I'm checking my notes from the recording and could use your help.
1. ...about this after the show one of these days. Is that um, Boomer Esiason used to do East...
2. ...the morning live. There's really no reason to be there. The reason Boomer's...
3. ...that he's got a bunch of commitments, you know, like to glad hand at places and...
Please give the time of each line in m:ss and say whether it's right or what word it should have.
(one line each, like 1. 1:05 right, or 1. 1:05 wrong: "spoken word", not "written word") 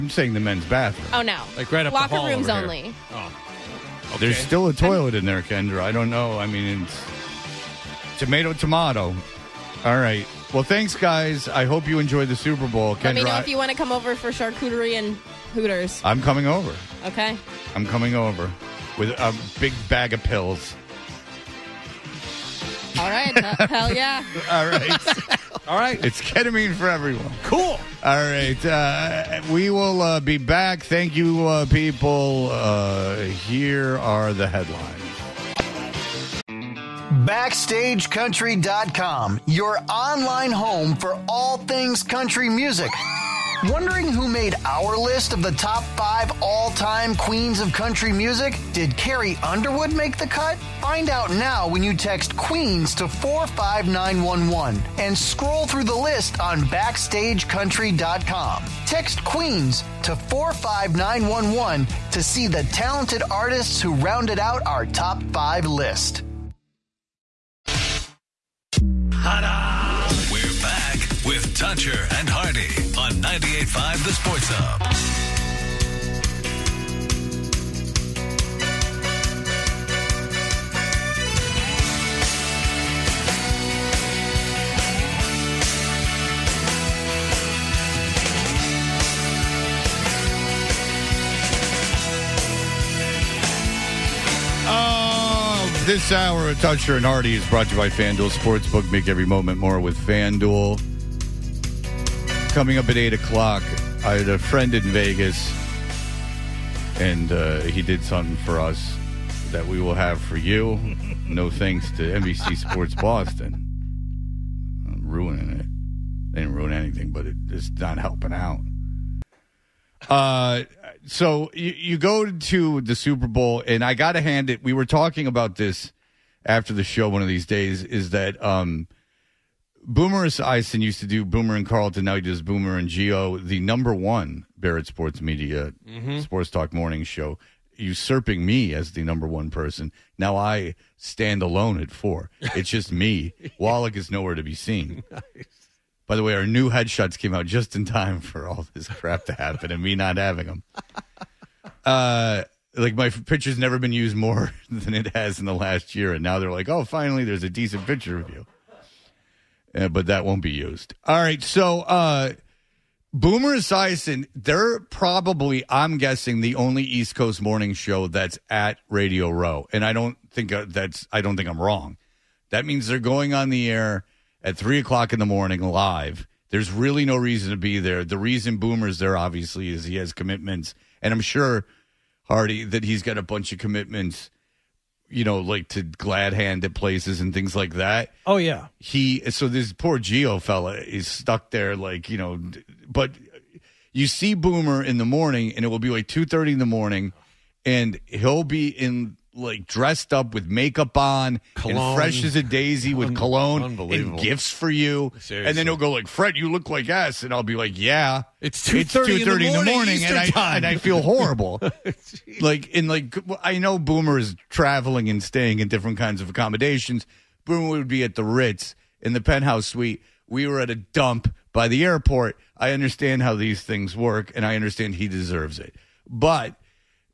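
1. 2:05 wrong: "Boomer", not "East"
2. 2:55 right
3. 3:02 right.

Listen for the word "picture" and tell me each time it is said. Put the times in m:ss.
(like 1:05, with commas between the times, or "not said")
2:33, 2:37.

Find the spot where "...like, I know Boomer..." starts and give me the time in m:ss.
3:32.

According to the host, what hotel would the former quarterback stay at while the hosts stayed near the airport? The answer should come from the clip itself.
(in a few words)
The Ritz.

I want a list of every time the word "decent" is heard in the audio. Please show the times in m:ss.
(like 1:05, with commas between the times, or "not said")
2:37.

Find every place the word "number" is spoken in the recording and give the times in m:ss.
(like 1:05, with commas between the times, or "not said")
2:13, 2:19.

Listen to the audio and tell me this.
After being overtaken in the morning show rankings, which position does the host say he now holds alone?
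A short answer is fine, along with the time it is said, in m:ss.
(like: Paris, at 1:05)
4, at 2:21.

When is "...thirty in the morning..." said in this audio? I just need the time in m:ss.
3:16.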